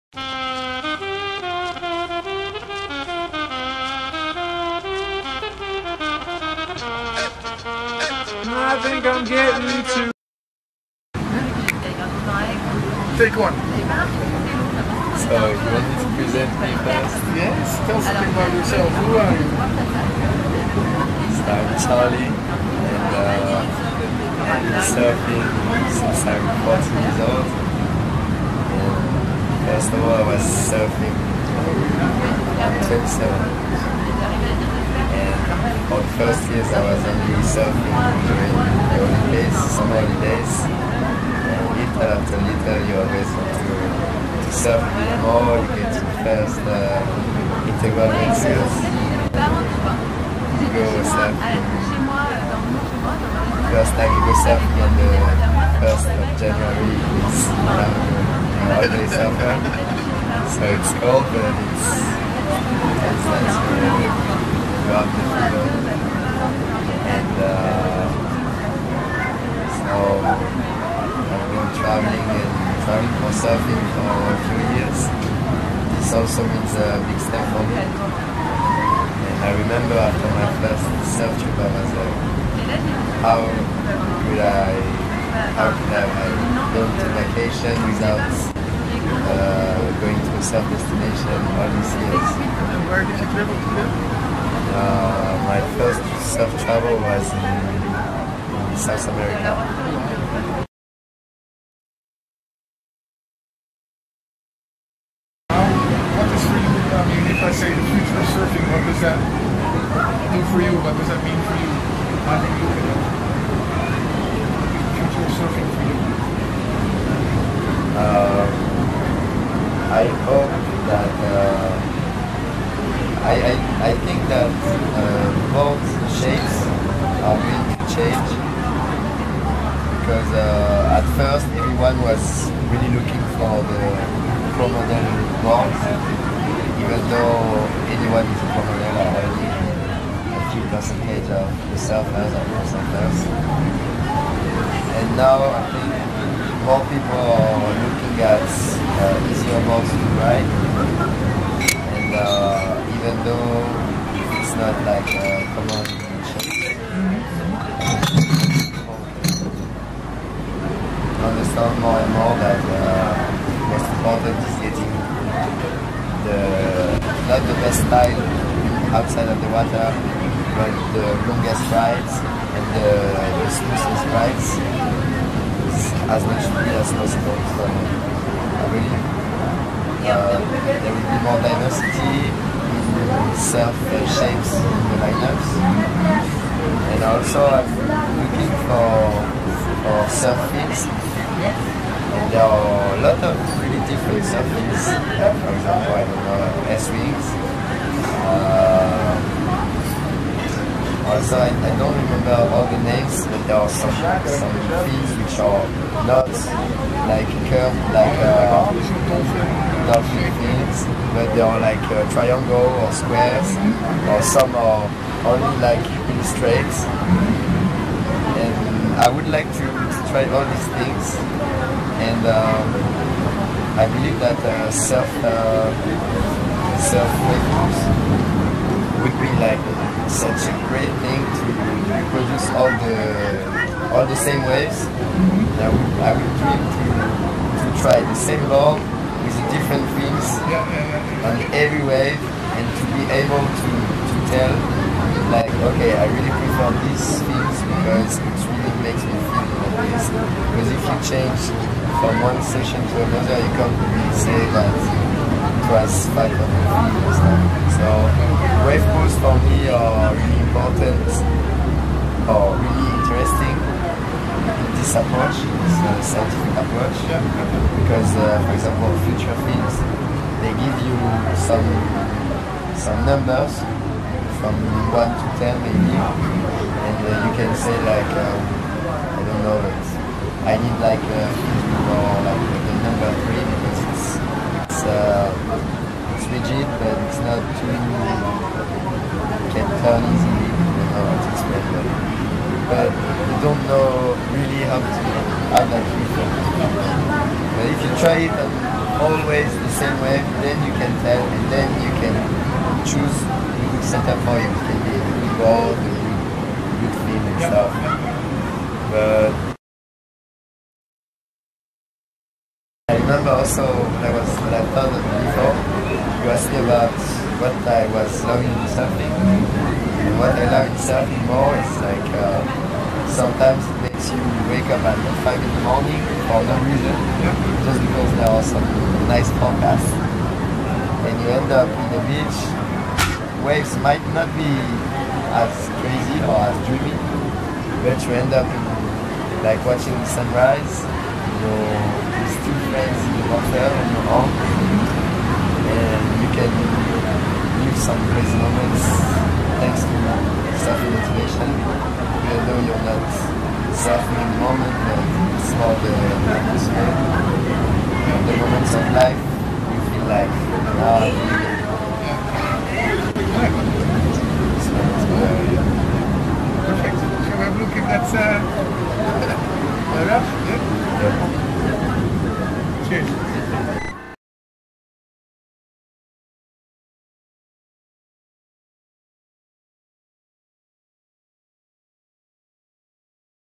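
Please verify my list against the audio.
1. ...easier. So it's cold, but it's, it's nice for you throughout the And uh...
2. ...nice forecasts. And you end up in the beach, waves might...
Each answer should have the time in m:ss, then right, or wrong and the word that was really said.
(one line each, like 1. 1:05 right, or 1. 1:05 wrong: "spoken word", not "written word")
1. 0:59 wrong: "surfer", not "easier"
2. 5:29 right.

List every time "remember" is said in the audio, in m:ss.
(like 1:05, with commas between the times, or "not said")
1:19, 3:21, 5:13.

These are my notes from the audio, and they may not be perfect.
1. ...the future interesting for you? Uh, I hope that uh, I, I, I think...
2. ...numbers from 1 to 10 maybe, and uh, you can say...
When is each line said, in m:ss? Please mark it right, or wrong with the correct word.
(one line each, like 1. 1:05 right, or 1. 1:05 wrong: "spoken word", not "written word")
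1. 1:53 wrong: "surfing", not "interesting"
2. 4:33 right.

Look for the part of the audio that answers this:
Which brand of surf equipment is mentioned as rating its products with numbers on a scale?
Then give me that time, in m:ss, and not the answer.
4:29.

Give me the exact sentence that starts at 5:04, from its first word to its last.
It can be a good ball, the good, good and stuff.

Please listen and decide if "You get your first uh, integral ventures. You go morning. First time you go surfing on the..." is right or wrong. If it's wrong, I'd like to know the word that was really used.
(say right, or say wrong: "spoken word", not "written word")
wrong: "surfing", not "morning".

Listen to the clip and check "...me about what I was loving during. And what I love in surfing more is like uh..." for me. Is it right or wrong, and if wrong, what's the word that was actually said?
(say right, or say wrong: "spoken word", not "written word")
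wrong: "surfing", not "during".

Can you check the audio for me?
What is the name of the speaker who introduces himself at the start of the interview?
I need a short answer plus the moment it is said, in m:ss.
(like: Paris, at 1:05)
Charlie, at 0:21.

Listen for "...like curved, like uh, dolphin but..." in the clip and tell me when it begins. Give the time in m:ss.
3:27.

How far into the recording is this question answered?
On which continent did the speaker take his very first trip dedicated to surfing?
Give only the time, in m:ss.
1:38.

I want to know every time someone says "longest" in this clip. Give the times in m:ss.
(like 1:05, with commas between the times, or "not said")
2:51.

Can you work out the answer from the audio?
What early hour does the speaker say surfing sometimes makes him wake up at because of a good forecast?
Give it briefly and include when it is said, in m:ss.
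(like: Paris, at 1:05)
5 in the morning, at 5:25.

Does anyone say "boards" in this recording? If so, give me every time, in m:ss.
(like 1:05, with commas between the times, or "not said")
2:15, 2:29.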